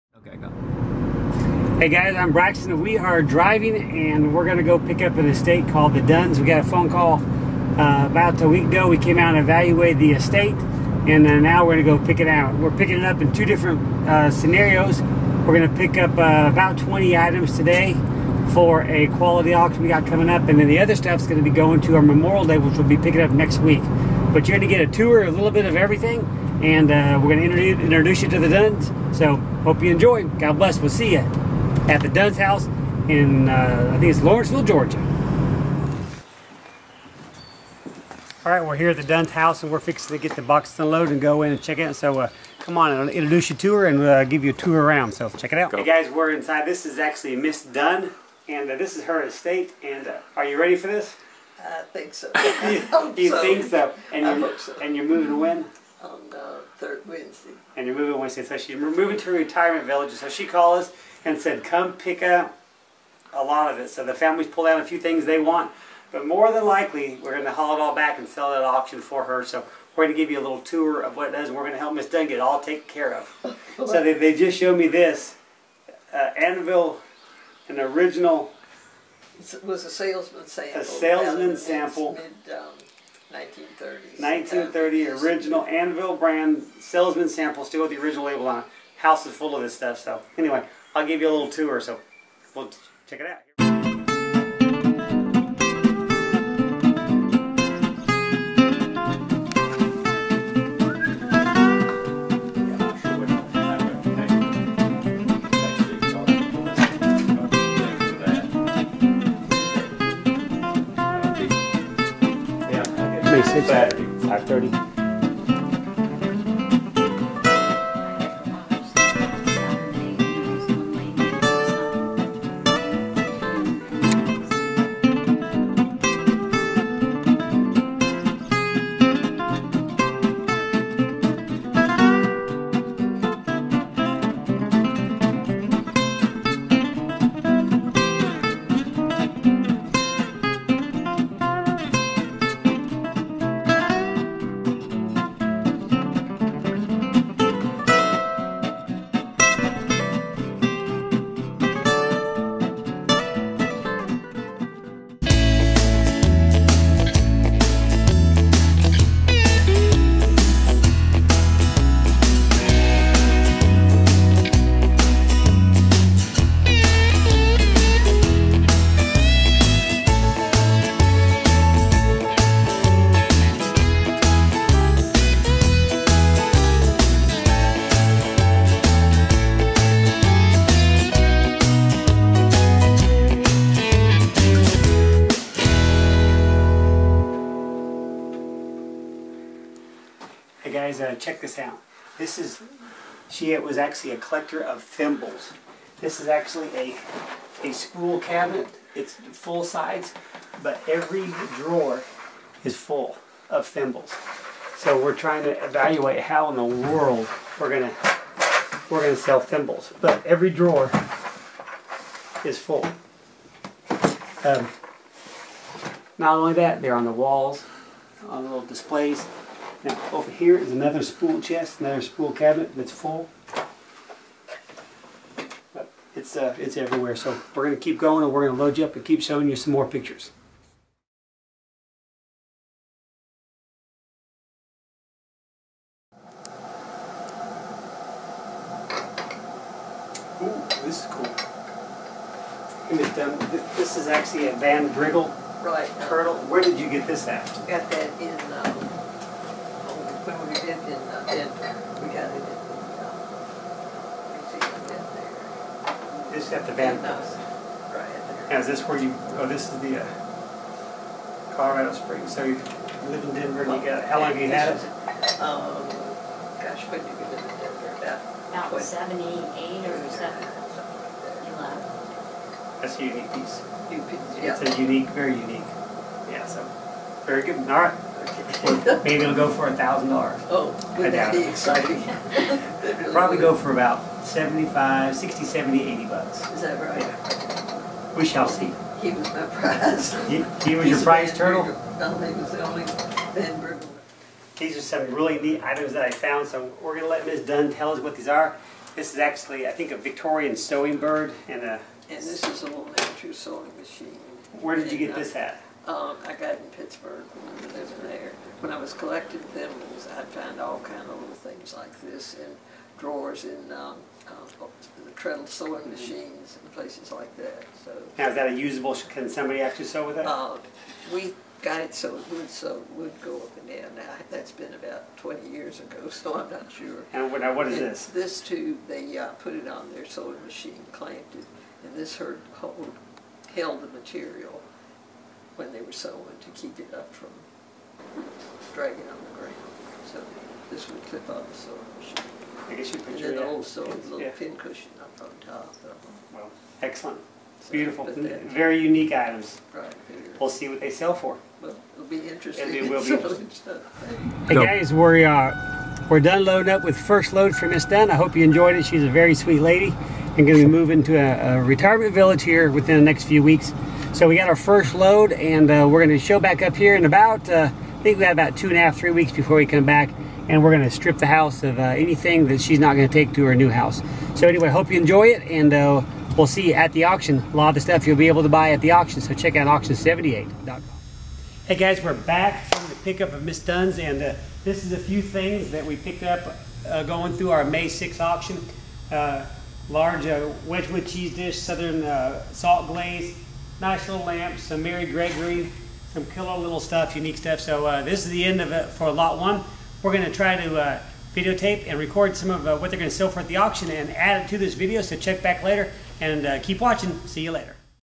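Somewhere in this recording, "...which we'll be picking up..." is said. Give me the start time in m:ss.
0:22.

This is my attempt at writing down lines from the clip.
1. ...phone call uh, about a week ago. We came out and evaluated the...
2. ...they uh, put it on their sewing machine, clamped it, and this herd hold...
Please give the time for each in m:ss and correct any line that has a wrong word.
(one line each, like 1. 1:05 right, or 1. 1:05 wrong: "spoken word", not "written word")
1. 0:06 right
2. 5:28 right.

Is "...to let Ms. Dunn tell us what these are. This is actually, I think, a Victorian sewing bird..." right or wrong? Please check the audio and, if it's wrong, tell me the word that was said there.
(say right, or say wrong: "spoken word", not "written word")
right.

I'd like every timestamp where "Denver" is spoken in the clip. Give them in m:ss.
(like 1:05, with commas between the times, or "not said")
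4:11, 4:23, 4:27.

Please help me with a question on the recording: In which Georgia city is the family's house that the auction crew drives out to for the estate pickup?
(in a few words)
Lawrenceville.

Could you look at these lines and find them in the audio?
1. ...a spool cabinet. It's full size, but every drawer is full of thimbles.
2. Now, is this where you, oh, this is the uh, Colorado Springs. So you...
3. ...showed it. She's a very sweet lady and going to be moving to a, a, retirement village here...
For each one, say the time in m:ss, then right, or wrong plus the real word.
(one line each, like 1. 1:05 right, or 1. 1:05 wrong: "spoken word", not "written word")
1. 3:17 right
2. 4:18 right
3. 5:58 wrong: "enjoyed", not "showed".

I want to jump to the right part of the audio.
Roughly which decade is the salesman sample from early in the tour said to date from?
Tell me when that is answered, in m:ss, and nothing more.
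1:23.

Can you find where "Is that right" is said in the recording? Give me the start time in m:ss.
4:46.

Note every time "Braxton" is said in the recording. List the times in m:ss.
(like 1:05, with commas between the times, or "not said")
0:02.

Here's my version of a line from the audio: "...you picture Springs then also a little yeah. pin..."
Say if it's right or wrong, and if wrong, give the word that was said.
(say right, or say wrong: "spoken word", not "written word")
wrong: "And", not "Springs".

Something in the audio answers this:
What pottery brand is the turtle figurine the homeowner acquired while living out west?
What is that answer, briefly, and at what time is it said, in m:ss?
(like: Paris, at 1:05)
Van Briggle, at 4:04.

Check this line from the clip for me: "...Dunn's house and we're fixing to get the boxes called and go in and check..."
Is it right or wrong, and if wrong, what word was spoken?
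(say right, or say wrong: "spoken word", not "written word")
wrong: "unloaded", not "called".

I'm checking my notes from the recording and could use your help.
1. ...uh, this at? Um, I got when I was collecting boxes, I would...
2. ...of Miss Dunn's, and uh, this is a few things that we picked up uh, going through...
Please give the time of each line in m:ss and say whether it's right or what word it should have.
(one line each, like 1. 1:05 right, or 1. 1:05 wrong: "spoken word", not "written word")
1. 5:05 wrong: "thimbles", not "boxes"
2. 6:23 right.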